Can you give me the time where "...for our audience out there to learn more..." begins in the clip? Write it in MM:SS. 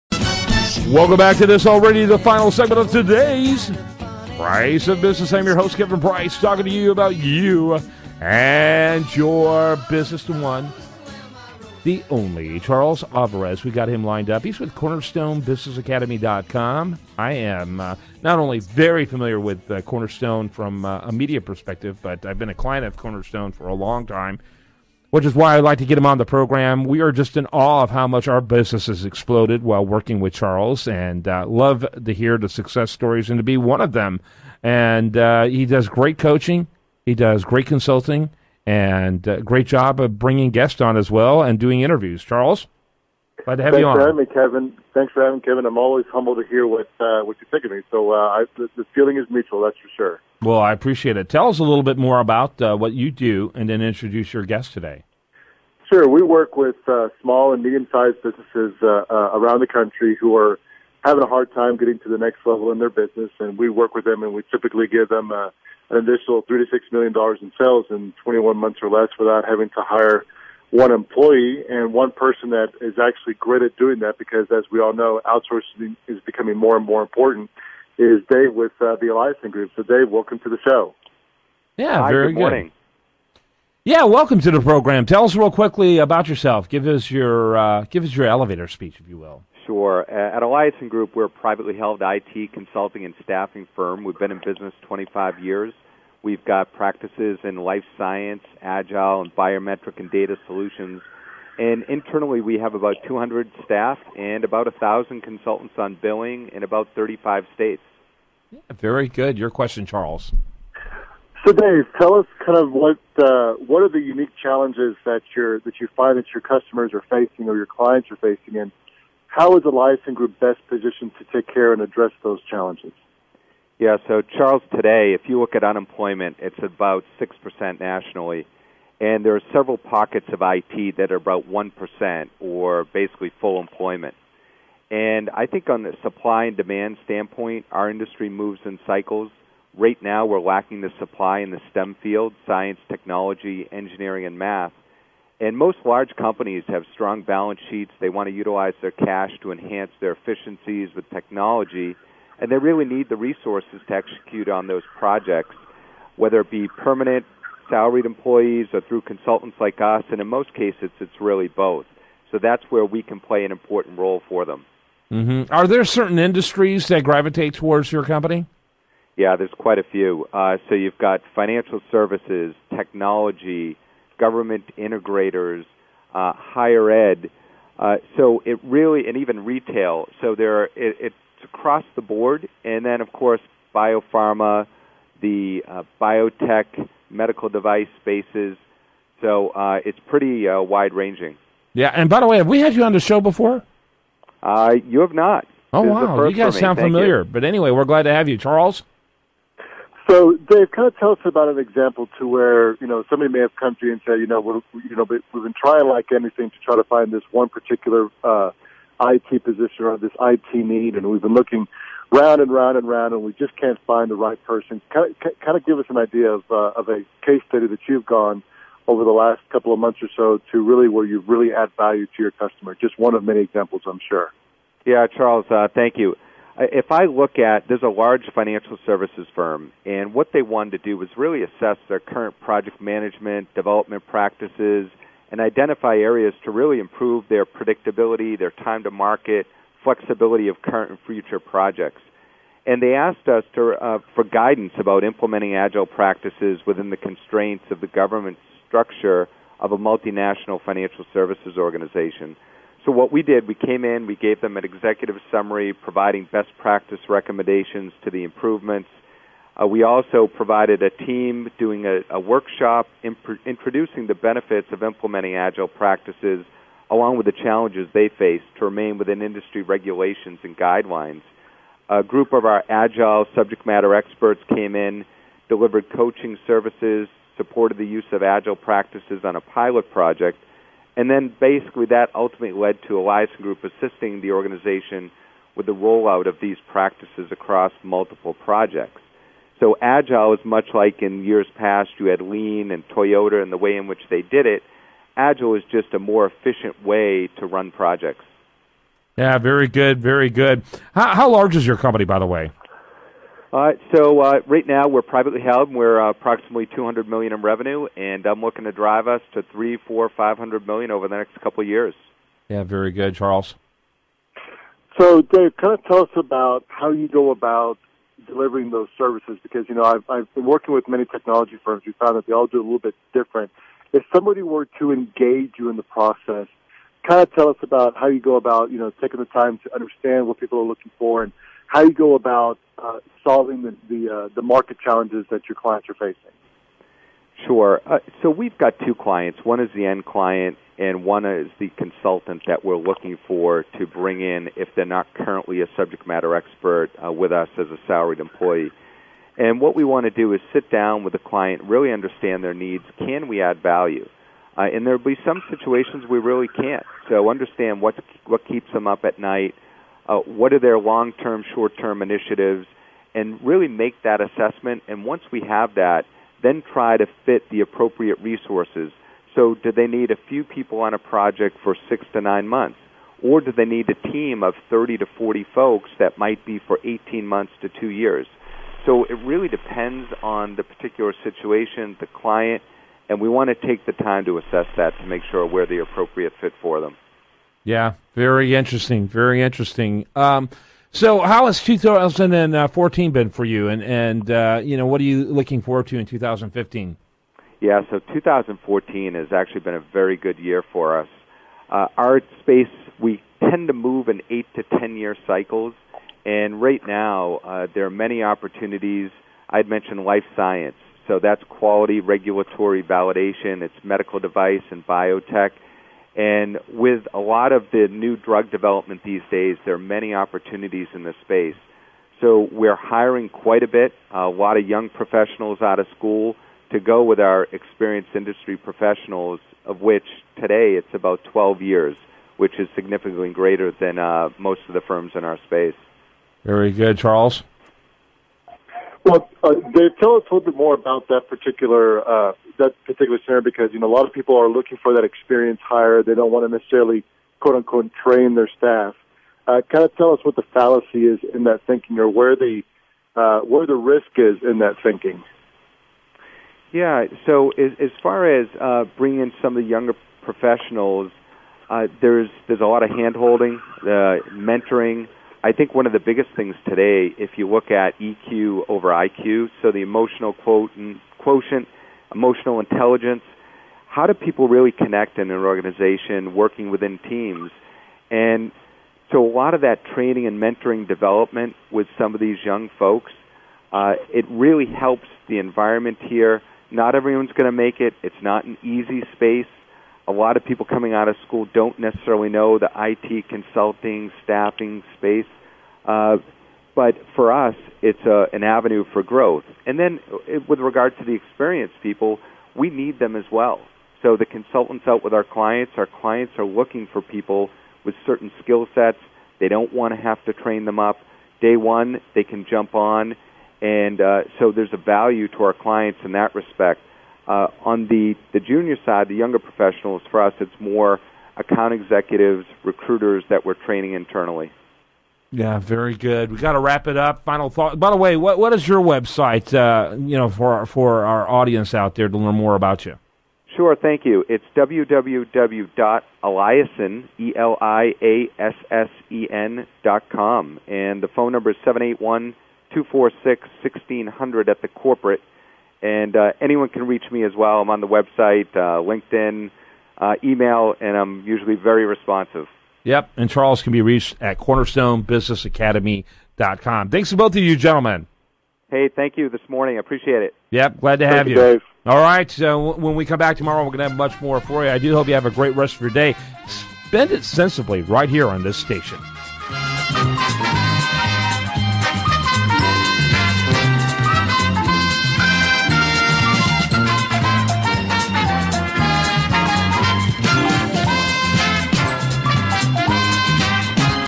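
08:50.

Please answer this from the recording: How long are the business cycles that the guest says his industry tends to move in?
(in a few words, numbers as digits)
8 to 10 years.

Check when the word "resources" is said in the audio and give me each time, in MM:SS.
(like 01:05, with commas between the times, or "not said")
02:33, 06:08.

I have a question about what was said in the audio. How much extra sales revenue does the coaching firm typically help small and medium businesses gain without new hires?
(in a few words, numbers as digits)
3 to 6 million dollars.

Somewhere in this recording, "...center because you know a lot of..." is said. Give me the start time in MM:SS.
07:23.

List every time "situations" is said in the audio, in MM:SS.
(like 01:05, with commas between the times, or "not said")
05:55, 06:21.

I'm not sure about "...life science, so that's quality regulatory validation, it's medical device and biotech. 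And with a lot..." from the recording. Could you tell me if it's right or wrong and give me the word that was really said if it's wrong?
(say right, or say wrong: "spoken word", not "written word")
right.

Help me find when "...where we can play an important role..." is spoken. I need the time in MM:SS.
02:42.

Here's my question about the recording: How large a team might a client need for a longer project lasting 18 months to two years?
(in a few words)
30 to 40 people.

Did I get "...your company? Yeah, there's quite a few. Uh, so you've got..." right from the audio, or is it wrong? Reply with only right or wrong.
right.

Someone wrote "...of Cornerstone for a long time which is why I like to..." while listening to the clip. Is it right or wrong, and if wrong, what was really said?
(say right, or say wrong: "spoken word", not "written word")
right.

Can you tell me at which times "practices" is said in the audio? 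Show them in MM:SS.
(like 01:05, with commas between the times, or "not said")
01:36, 03:54, 04:05, 04:16, 04:25, 04:38, 04:46.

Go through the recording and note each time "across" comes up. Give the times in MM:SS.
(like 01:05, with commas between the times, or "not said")
03:01, 04:47.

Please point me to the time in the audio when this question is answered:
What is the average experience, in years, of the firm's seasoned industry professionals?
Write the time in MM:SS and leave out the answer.
07:11.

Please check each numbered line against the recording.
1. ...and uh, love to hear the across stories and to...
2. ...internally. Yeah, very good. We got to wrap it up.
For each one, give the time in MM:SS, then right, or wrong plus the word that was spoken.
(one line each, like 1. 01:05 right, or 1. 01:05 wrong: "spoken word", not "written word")
1. 00:30 wrong: "success", not "across"
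2. 08:43 right.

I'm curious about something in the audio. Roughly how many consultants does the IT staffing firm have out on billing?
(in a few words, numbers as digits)
1,000.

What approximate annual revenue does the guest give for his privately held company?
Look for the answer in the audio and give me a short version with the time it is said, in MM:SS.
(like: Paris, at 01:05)
200 million, at 05:06.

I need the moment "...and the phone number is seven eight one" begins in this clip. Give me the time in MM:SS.
09:00.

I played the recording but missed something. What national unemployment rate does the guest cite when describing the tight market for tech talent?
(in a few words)
6%.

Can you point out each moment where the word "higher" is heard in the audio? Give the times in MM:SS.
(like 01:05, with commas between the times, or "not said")
02:56.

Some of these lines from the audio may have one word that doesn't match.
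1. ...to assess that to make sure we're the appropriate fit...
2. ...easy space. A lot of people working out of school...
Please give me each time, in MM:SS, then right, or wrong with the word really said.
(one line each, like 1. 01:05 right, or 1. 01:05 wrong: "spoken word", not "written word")
1. 06:24 right
2. 08:08 wrong: "coming", not "working".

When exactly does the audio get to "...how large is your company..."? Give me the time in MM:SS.
05:01.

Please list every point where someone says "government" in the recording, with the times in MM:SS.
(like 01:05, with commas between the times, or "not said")
02:54, 04:07.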